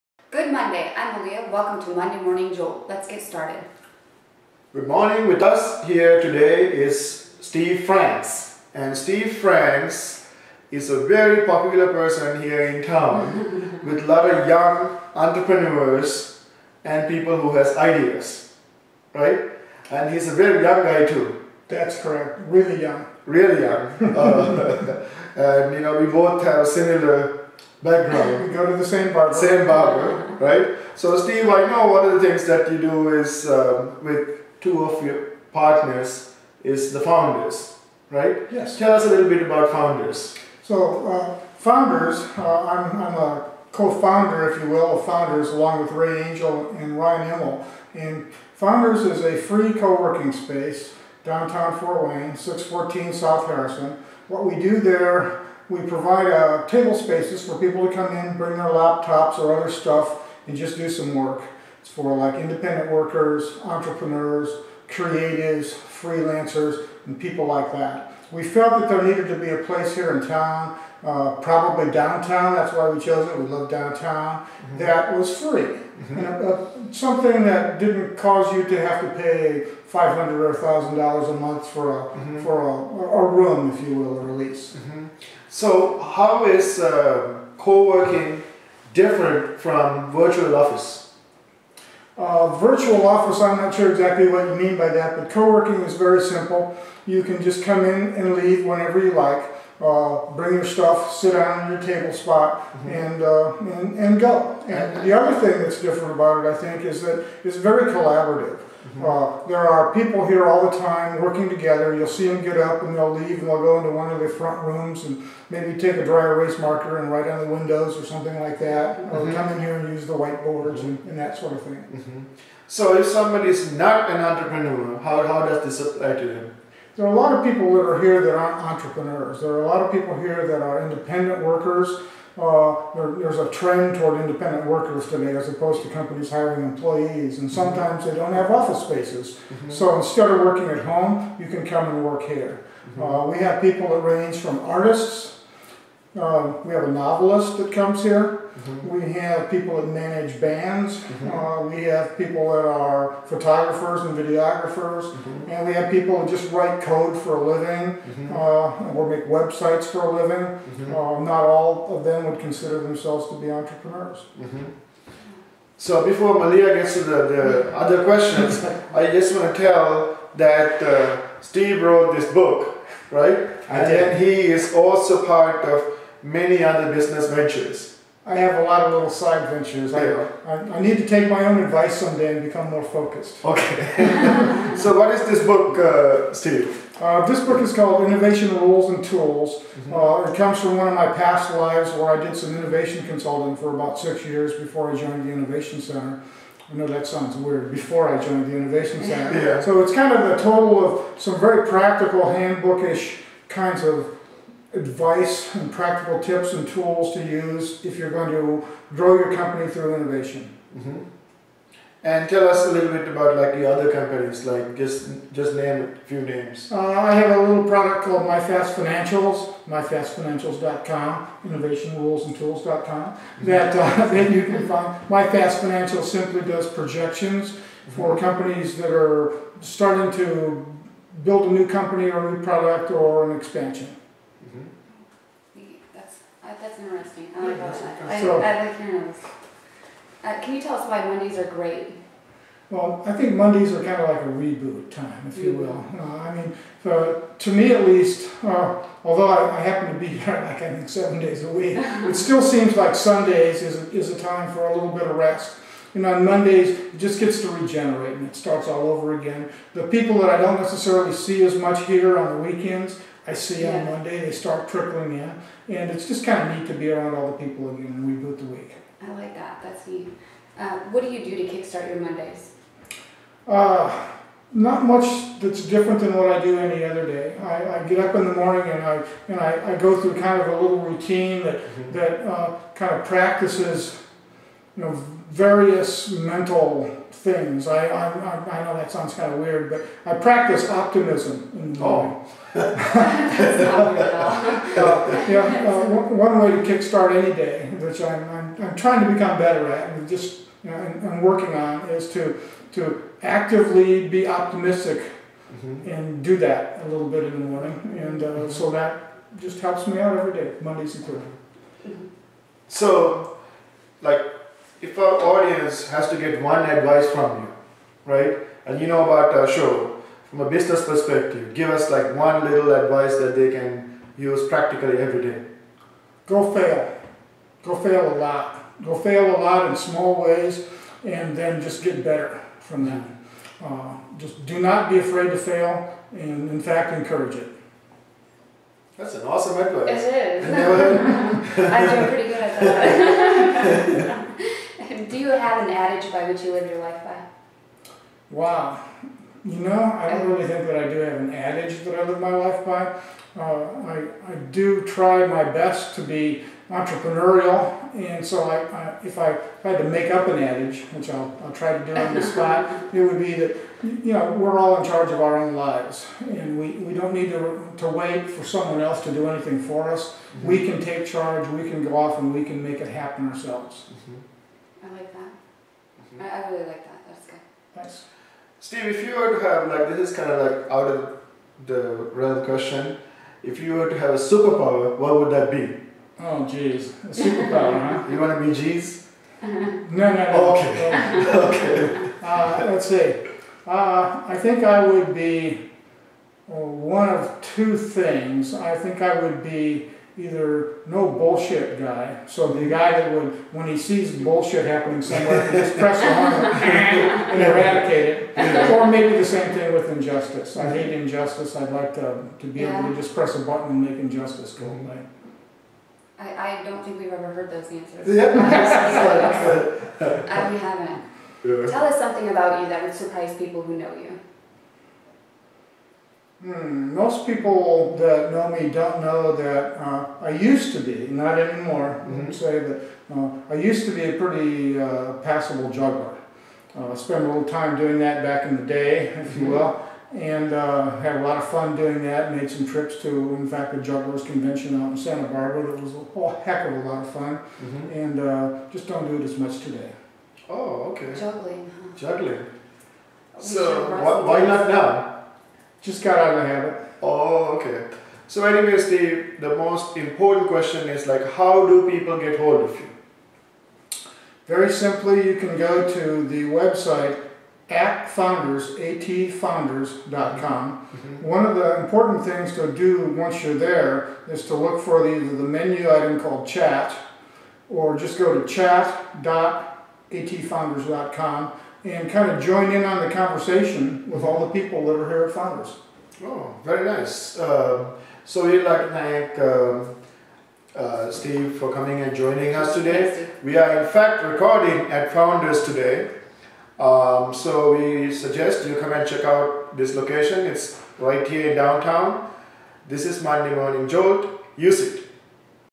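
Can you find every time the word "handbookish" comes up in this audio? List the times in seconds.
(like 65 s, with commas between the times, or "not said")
202 s.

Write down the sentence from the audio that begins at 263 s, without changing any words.
on Monday, they start trickling in.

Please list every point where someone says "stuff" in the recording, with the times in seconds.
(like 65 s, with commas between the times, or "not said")
59 s, 100 s.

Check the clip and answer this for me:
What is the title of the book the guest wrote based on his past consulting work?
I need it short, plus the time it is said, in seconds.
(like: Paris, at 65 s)
Innovation Rules and Tools, at 188 s.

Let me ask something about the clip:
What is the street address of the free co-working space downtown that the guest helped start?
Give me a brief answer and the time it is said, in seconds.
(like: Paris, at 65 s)
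614 South Harrison, at 52 s.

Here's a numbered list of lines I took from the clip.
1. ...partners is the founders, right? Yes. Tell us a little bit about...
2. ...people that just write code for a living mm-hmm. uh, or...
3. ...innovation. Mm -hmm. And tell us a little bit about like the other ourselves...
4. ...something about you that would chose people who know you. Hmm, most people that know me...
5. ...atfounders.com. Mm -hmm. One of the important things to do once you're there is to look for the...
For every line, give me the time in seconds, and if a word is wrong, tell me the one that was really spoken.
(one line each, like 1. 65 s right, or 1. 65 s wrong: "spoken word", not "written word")
1. 35 s right
2. 155 s right
3. 209 s wrong: "companies", not "ourselves"
4. 421 s wrong: "surprise", not "chose"
5. 468 s right.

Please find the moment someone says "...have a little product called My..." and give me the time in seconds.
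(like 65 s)
217 s.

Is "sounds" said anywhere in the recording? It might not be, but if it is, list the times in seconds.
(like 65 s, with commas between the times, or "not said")
197 s, 288 s.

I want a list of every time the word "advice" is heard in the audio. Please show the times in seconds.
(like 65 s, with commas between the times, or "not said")
181 s, 204 s, 316 s, 322 s, 339 s.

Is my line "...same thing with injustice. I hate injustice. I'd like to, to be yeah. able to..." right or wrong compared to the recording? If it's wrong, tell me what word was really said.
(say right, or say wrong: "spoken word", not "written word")
right.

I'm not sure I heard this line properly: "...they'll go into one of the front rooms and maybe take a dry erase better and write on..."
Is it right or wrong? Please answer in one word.
wrong.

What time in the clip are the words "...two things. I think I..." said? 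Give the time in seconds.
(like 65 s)
397 s.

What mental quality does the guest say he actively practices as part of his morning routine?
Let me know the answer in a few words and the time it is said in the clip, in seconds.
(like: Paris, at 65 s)
Optimism, at 290 s.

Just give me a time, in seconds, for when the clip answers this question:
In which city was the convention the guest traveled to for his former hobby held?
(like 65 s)
445 s.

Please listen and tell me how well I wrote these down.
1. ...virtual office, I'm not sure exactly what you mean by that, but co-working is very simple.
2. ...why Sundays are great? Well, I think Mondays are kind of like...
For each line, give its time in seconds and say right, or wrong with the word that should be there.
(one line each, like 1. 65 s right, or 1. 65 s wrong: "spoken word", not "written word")
1. 92 s right
2. 240 s wrong: "Mondays", not "Sundays".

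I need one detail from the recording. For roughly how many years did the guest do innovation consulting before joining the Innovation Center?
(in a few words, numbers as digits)
6.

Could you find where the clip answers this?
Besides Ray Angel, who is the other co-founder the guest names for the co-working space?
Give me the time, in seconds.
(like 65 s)
46 s.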